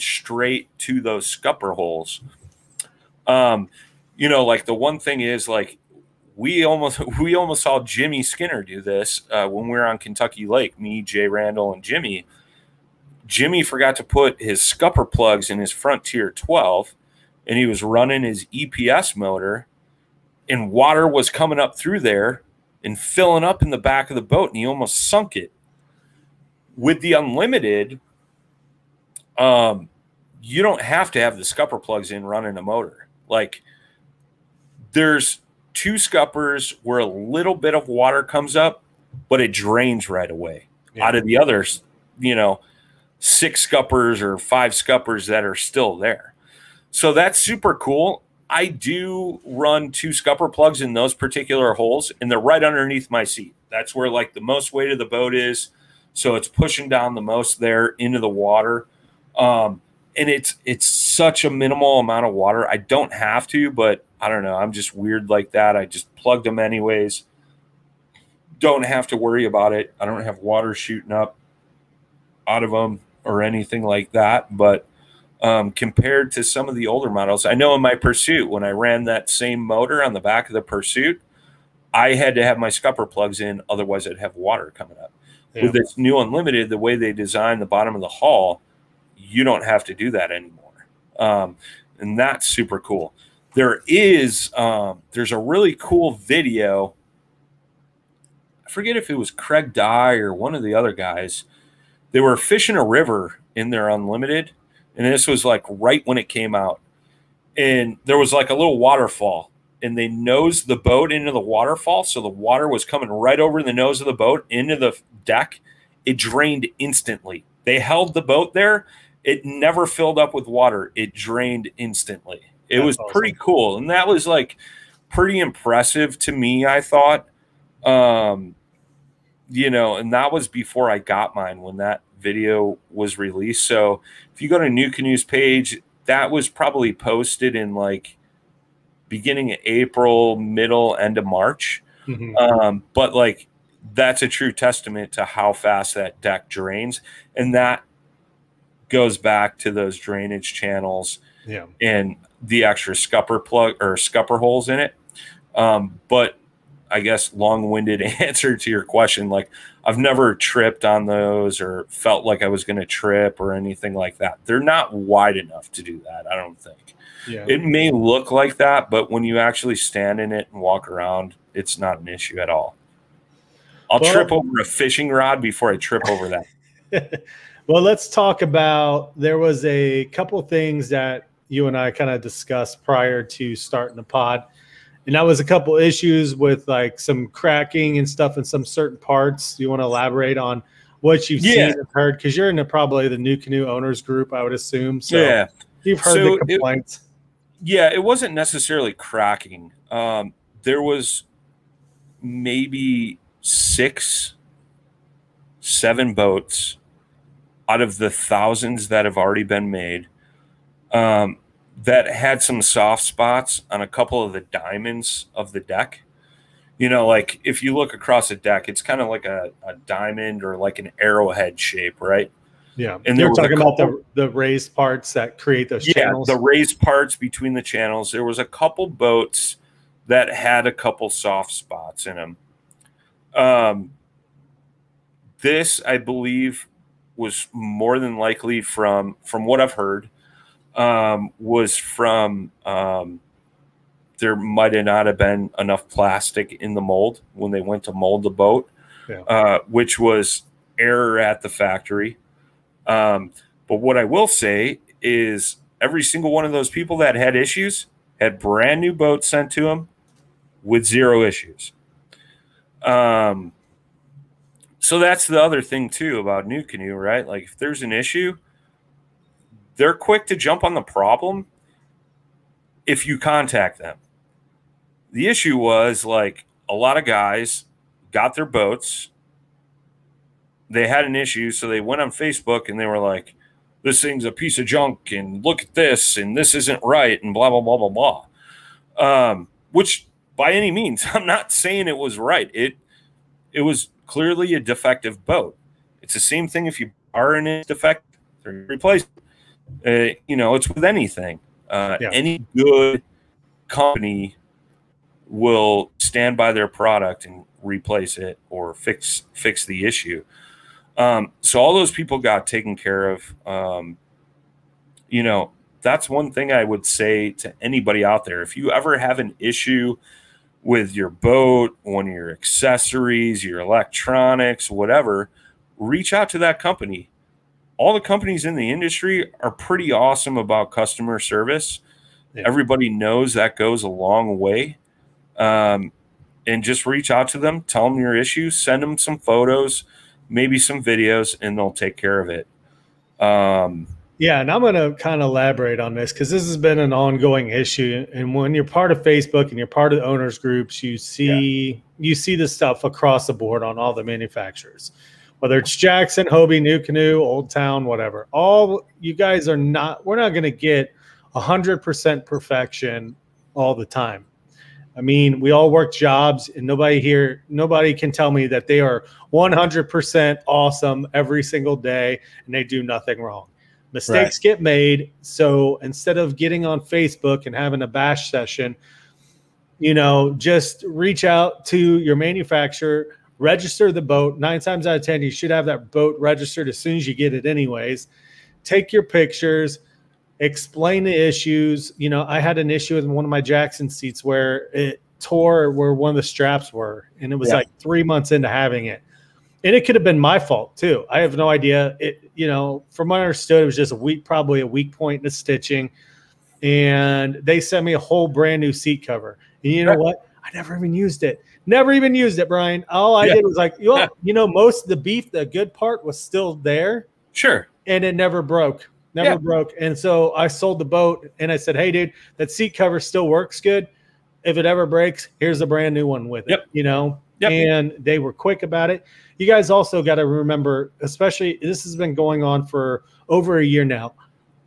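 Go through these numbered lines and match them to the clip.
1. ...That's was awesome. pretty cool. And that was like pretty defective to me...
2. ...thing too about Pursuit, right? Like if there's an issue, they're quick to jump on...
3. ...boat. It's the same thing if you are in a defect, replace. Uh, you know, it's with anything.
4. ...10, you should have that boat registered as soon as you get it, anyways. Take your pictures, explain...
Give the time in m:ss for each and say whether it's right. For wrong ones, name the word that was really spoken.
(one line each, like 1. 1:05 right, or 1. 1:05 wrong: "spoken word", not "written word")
1. 2:02 wrong: "impressive", not "defective"
2. 4:25 wrong: "NuCanoe", not "Pursuit"
3. 4:55 right
4. 6:25 right.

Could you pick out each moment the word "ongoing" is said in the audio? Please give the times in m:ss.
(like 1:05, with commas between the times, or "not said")
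5:46.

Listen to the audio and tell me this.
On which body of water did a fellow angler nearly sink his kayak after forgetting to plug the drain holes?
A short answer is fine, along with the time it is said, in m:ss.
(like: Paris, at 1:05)
Kentucky Lake, at 0:09.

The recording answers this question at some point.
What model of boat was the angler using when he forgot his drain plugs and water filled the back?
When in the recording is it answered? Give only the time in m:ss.
0:15.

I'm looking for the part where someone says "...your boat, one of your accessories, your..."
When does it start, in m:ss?
5:20.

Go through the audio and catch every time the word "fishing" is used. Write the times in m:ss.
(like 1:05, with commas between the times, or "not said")
1:42, 2:54.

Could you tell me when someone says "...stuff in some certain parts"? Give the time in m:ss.
3:08.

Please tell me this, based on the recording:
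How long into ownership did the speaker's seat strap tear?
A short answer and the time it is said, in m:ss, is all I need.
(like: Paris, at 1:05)
3 months, at 6:37.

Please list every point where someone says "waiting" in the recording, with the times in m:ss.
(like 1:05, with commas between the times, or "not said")
not said.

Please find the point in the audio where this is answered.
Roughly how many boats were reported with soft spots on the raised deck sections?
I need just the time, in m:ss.
3:23.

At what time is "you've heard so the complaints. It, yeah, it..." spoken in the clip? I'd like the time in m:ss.
3:15.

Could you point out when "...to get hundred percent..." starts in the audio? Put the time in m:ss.
6:00.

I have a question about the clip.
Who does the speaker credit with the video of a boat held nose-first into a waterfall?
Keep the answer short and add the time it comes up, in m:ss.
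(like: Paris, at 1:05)
Craig Dye, at 1:39.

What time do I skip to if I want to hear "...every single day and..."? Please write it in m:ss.
6:11.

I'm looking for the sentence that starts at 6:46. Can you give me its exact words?
And they sent me a whole brand new seat cover.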